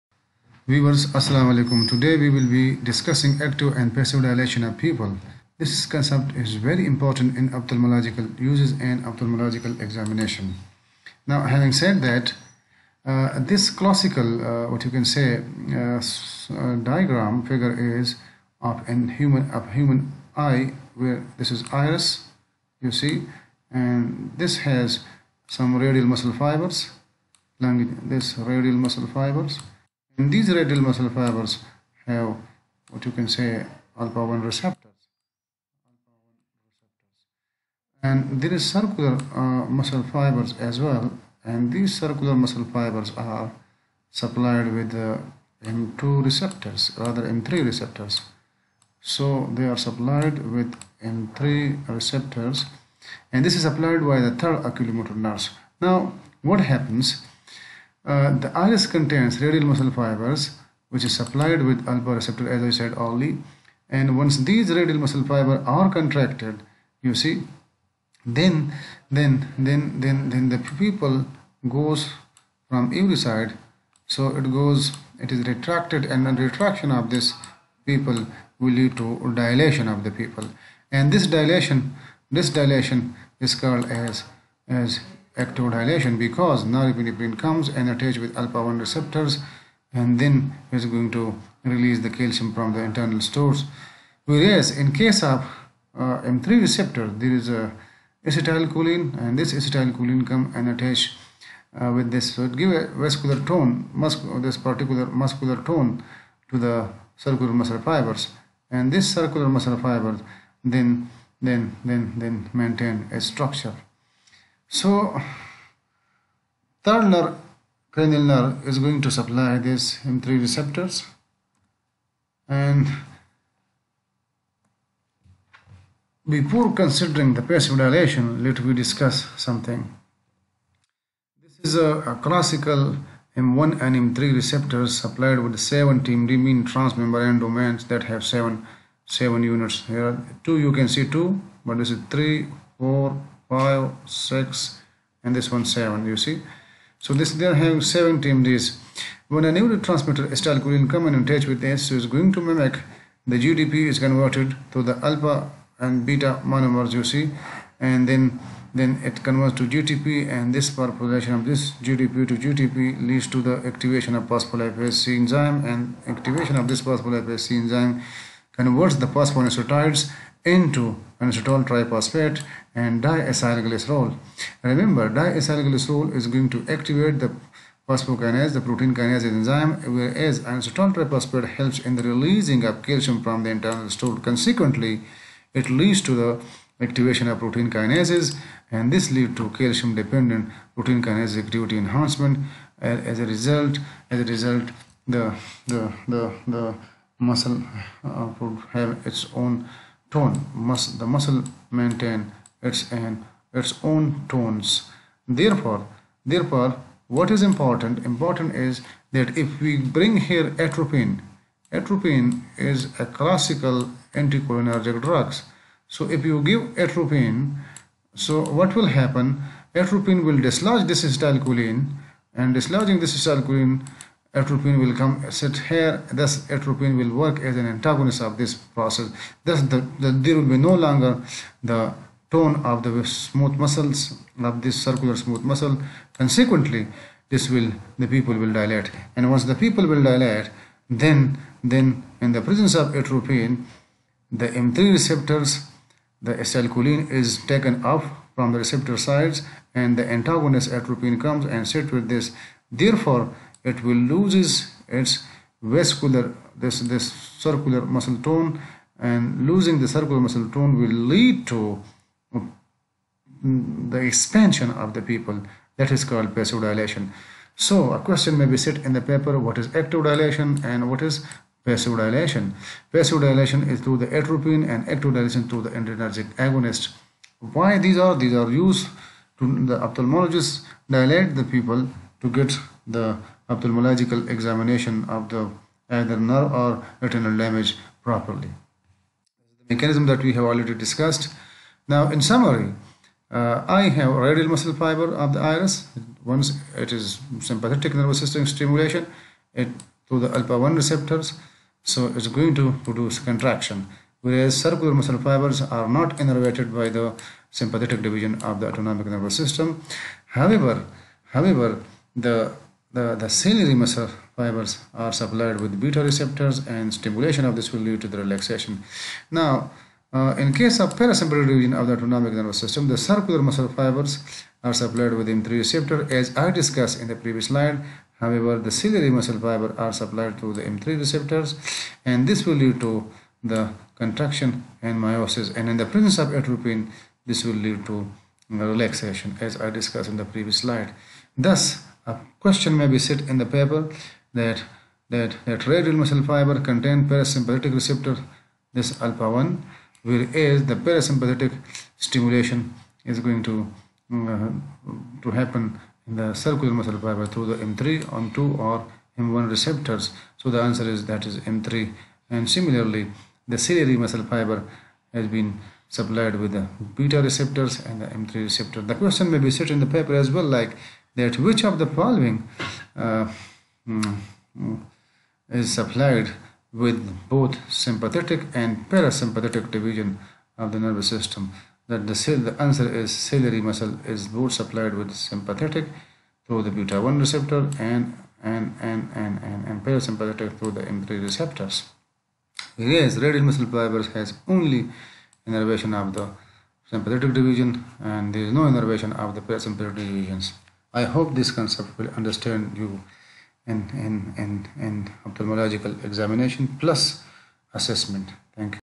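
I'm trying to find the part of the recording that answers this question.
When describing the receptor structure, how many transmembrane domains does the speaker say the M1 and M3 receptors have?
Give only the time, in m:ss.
2:15.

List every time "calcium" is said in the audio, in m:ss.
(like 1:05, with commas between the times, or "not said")
1:32, 3:02, 3:09.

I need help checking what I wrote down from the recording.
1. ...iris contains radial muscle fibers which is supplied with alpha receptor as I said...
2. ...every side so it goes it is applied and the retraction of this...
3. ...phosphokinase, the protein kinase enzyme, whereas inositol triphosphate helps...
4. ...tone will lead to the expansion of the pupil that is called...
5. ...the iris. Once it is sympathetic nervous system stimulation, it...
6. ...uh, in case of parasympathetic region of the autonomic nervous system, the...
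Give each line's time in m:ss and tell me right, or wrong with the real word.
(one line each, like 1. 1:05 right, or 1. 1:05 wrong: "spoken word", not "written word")
1. 0:58 right
2. 1:13 wrong: "retracted", not "applied"
3. 2:57 right
4. 4:20 right
5. 4:55 right
6. 5:20 right.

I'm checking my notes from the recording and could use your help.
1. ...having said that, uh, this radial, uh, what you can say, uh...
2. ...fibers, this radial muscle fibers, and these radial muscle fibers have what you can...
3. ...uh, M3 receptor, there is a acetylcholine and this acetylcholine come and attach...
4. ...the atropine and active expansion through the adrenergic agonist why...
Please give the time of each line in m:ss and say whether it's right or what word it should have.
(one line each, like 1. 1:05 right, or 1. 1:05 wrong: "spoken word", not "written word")
1. 0:11 wrong: "classical", not "radial"
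2. 0:26 right
3. 1:35 right
4. 4:34 wrong: "dilation", not "expansion".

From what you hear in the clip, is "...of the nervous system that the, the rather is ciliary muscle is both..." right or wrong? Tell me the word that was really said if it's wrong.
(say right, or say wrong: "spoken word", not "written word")
wrong: "answer", not "rather".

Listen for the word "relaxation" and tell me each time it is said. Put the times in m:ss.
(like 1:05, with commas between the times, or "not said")
5:18, 5:38.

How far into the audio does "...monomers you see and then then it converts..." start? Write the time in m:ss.
2:36.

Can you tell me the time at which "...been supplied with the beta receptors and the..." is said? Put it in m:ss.
6:05.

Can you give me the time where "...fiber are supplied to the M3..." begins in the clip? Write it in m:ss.
5:29.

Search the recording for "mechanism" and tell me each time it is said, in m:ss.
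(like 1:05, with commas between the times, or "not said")
4:49.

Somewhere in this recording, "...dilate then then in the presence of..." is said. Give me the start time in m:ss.
4:00.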